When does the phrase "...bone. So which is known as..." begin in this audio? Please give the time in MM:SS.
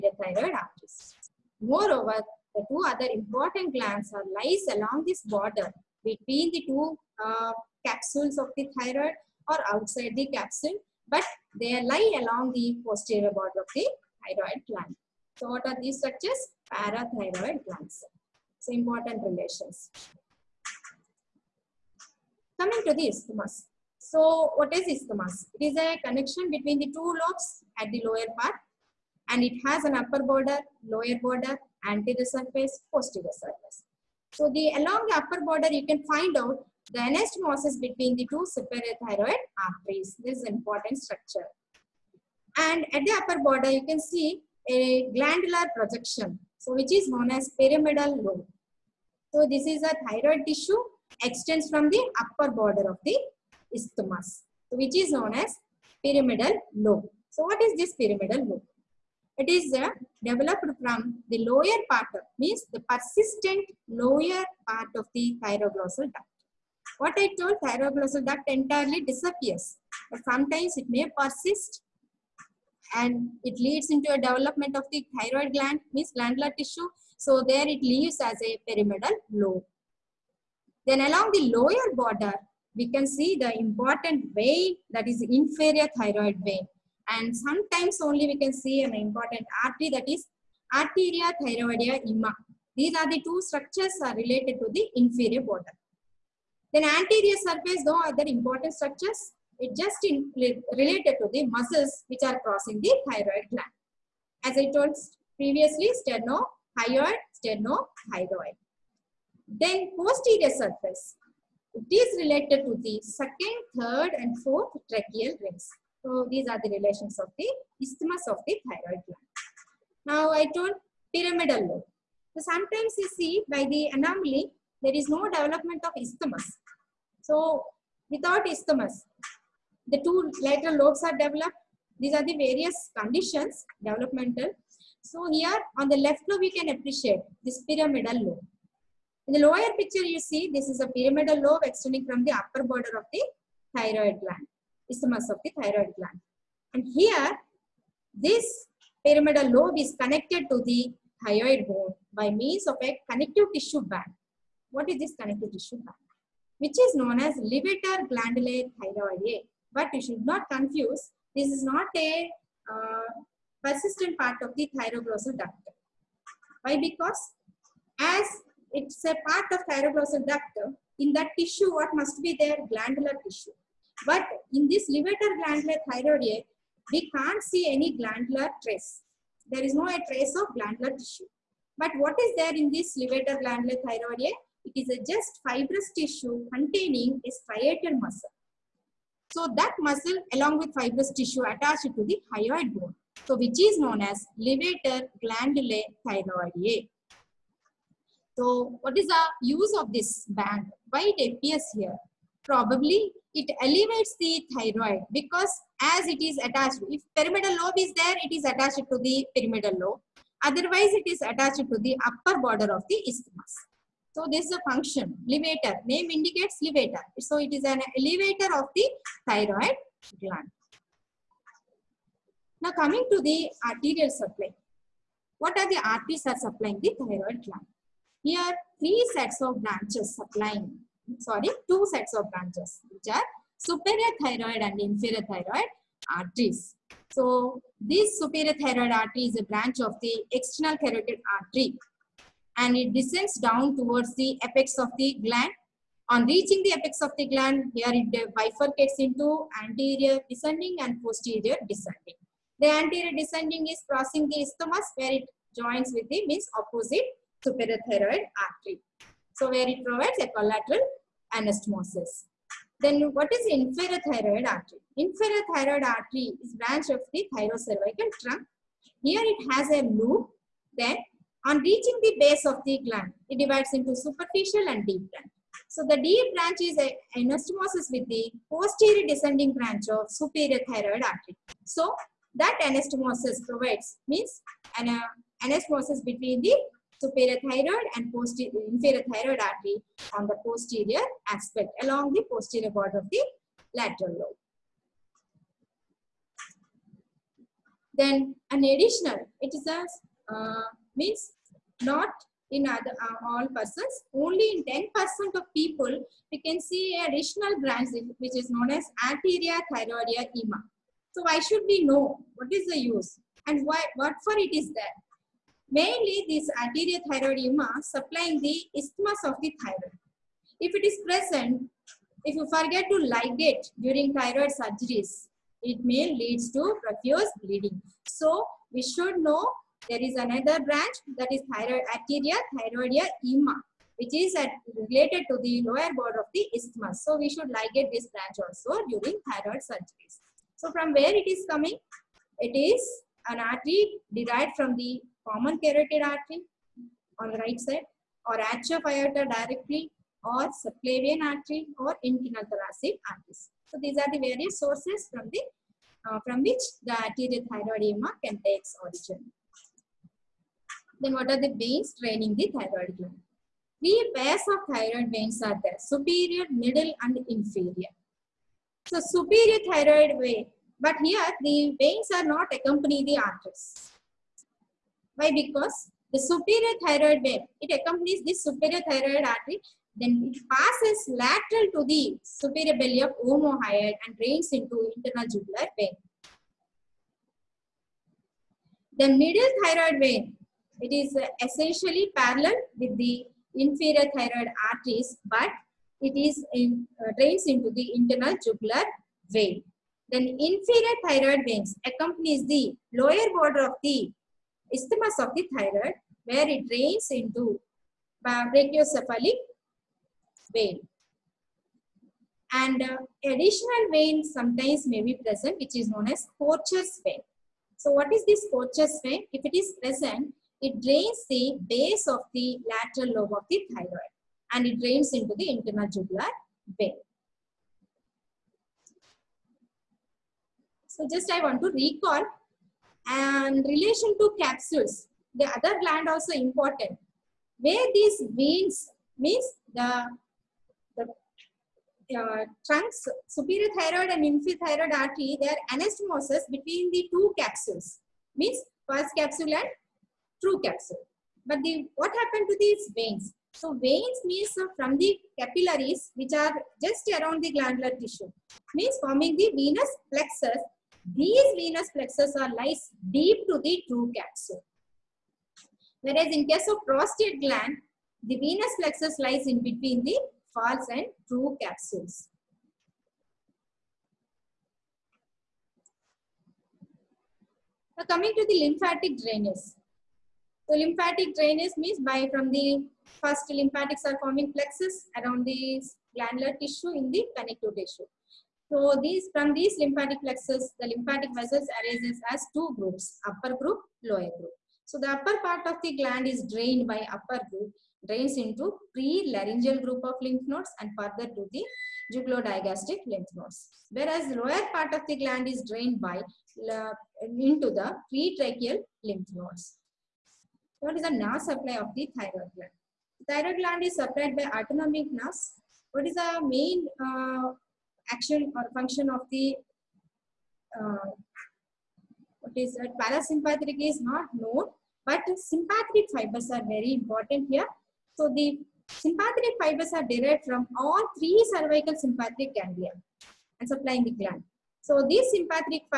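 03:12.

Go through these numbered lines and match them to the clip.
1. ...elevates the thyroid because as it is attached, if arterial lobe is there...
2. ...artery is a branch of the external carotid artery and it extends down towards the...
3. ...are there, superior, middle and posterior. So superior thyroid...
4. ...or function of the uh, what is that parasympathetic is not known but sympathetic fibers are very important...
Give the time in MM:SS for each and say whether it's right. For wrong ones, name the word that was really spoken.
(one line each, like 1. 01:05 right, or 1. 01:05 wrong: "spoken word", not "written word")
1. 03:23 wrong: "pyramidal", not "arterial"
2. 03:58 wrong: "descends", not "extends"
3. 06:05 wrong: "inferior", not "posterior"
4. 08:38 right.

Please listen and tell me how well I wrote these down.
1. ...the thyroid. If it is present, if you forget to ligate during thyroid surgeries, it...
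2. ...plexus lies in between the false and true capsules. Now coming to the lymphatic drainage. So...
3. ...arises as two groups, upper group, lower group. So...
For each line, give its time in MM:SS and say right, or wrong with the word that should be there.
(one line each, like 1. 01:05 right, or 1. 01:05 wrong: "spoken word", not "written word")
1. 05:19 right
2. 07:48 right
3. 08:11 right.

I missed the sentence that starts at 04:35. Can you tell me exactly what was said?
So the deep branch is a anastomosis with the posterior descending branch of superior thyroid artery.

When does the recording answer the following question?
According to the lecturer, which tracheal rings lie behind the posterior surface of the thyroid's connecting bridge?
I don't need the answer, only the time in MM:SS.
01:53.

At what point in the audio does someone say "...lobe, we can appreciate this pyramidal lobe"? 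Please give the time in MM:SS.
02:16.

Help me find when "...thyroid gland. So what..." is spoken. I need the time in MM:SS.
00:14.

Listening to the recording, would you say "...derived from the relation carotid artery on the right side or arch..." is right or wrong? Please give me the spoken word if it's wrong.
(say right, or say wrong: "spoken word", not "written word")
wrong: "common", not "relation".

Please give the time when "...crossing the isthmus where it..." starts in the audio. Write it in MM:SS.
04:13.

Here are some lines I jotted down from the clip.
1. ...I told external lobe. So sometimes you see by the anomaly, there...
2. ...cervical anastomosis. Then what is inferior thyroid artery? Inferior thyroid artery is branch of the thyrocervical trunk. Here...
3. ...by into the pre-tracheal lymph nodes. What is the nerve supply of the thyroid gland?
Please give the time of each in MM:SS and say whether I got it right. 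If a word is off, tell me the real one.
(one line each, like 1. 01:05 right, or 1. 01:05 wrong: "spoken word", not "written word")
1. 02:00 wrong: "pyramidal", not "external"
2. 04:20 wrong: "collateral", not "cervical"
3. 08:25 right.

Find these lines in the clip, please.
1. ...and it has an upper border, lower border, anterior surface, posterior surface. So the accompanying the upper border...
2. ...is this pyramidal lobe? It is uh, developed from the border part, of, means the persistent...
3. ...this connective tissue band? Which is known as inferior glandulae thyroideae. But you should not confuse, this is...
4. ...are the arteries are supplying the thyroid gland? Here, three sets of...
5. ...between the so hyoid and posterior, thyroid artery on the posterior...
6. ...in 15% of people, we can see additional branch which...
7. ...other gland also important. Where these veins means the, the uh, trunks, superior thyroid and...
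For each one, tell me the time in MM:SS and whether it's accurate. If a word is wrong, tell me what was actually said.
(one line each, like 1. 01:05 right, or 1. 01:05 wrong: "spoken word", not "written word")
1. 00:29 wrong: "along", not "accompanying"
2. 00:57 wrong: "lower", not "border"
3. 02:34 wrong: "levator", not "inferior"
4. 03:45 right
5. 04:46 wrong: "parathyroid", not "hyoid"
6. 05:04 wrong: "10", not "15"
7. 07:15 right.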